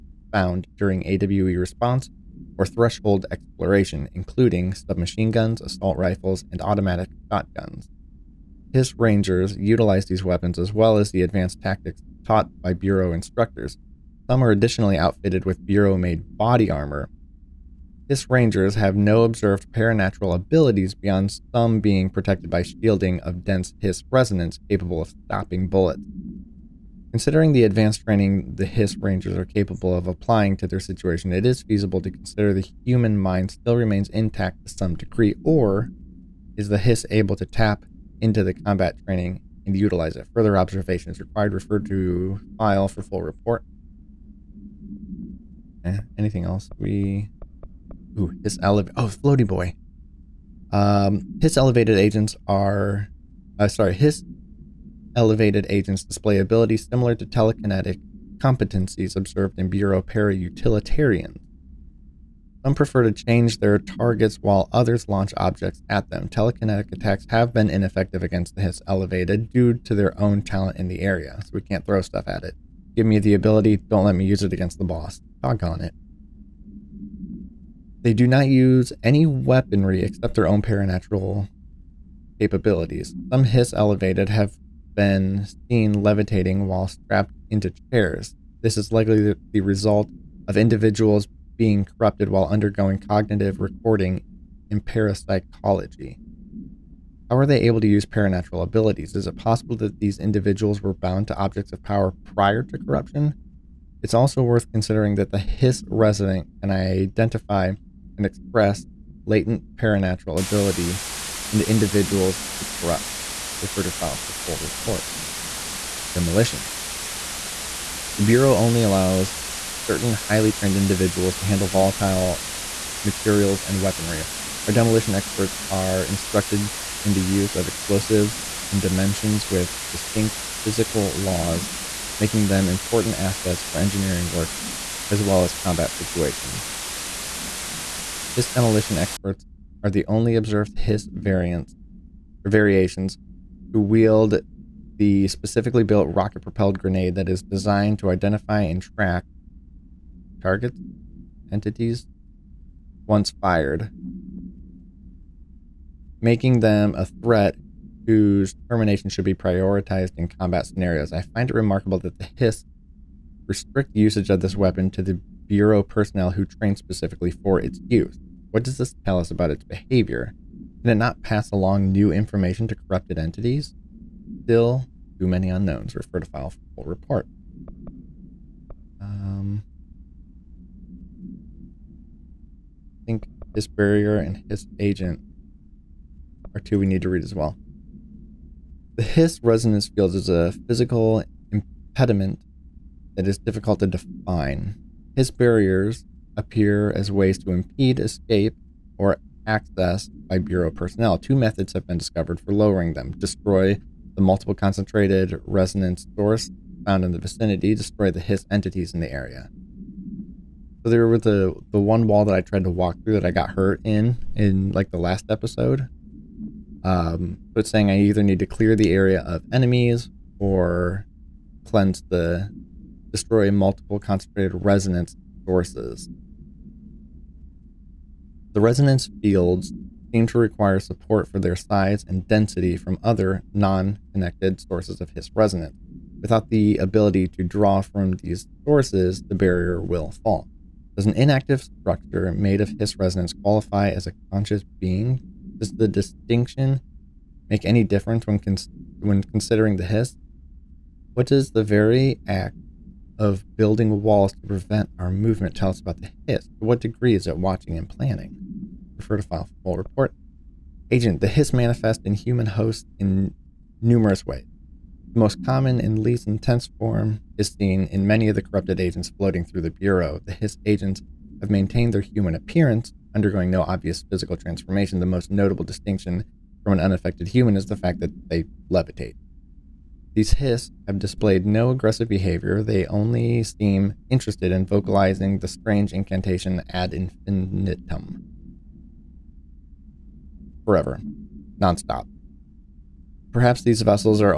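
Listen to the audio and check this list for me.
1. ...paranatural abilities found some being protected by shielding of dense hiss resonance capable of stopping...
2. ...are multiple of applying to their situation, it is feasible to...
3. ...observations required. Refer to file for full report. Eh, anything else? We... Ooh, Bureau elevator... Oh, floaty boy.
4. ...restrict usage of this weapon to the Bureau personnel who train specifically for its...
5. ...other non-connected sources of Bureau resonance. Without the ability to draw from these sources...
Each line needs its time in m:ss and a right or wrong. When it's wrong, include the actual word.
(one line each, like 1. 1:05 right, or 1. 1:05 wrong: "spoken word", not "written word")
1. 0:19 wrong: "beyond", not "found"
2. 0:29 wrong: "capable", not "multiple"
3. 0:40 wrong: "Hiss", not "Bureau"
4. 2:43 right
5. 3:53 wrong: "Hiss", not "Bureau".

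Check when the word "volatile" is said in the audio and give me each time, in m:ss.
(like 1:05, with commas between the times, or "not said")
2:01.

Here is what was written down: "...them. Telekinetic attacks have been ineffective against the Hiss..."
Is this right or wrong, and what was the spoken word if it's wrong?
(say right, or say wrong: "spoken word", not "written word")
right.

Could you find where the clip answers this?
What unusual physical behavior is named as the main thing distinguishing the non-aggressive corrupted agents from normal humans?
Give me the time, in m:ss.
4:38.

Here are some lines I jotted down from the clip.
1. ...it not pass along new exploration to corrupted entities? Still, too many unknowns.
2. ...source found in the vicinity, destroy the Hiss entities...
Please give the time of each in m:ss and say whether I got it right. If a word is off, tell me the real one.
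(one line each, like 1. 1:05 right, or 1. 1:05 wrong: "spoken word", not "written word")
1. 2:50 wrong: "information", not "exploration"
2. 3:26 right.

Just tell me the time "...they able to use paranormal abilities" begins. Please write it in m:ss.
1:37.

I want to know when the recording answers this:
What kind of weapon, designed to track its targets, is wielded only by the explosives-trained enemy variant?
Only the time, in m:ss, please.
2:26.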